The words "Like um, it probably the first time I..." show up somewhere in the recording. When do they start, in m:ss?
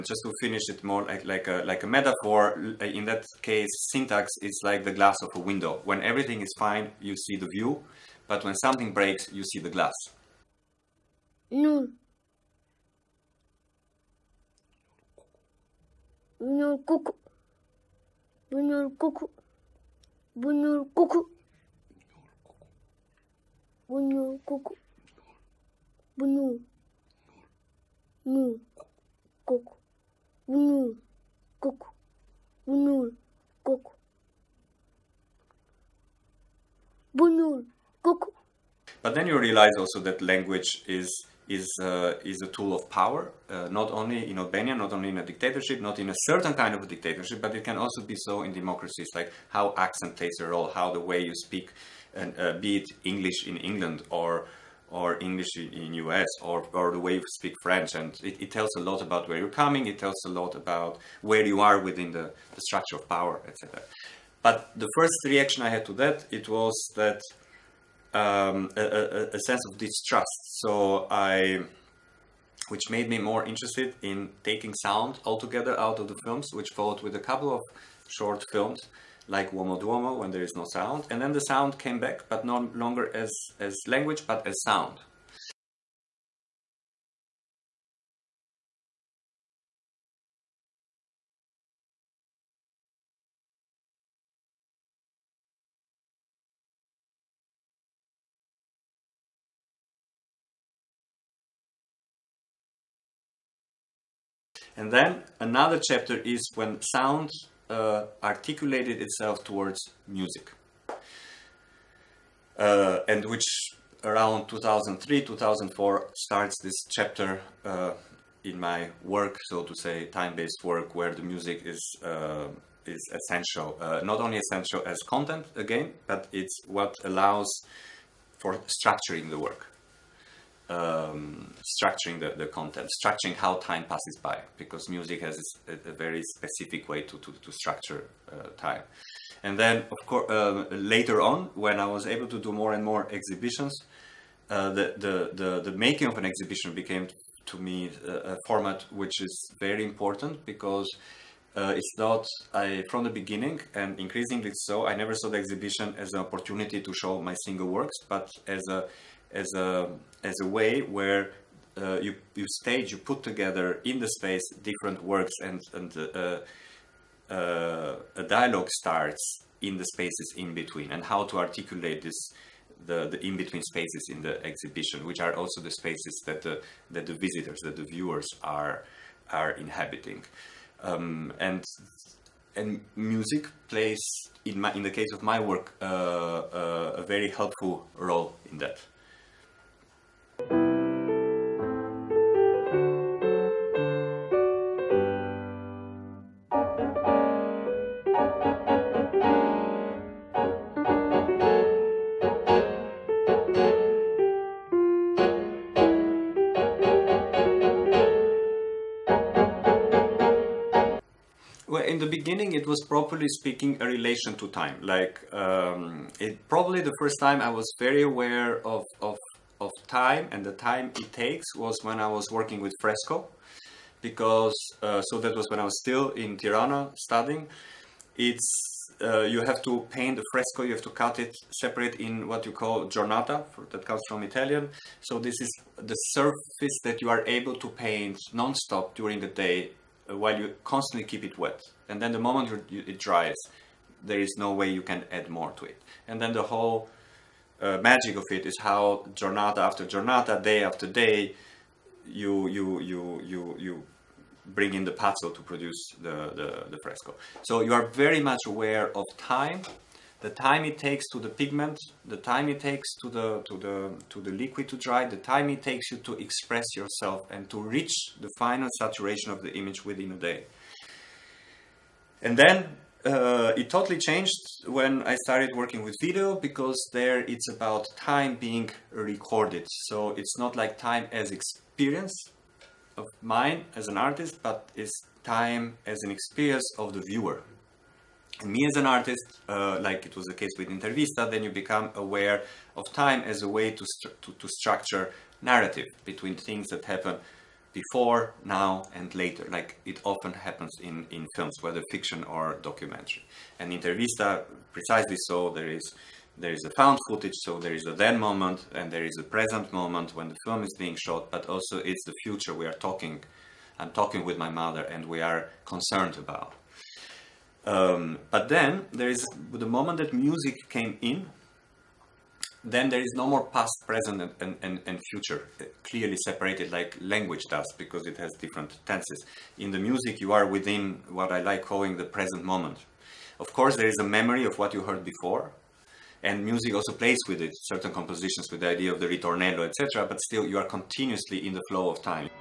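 3:34.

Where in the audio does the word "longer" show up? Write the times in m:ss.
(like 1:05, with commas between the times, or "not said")
1:22.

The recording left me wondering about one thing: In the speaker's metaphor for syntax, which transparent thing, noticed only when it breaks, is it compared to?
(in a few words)
the glass of a window.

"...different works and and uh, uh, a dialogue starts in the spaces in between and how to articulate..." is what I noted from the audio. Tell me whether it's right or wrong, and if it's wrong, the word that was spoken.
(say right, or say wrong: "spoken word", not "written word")
right.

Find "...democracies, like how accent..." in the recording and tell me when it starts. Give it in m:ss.
0:48.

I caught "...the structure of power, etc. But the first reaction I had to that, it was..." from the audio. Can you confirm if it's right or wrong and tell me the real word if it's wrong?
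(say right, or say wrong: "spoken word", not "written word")
right.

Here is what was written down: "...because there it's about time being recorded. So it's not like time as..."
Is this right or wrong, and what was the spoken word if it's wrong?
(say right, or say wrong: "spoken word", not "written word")
right.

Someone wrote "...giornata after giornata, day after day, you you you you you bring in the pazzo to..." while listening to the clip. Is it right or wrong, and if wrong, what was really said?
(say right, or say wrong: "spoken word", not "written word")
right.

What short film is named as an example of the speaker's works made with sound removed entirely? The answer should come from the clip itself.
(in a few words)
Uomo Duomo.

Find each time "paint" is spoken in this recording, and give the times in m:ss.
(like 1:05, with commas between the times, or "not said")
3:49, 3:57.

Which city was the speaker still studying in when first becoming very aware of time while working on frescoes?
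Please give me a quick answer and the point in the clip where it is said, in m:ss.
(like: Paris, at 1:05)
Tirana, at 3:46.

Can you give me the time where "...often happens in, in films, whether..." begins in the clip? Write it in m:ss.
5:00.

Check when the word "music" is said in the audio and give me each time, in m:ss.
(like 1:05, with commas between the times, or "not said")
1:50, 2:01, 2:14, 3:02, 5:20, 5:29, 5:36.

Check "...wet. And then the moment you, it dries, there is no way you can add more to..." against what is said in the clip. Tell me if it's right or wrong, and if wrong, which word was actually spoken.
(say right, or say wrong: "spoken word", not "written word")
right.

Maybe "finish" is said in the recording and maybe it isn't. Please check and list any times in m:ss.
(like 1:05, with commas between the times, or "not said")
0:00.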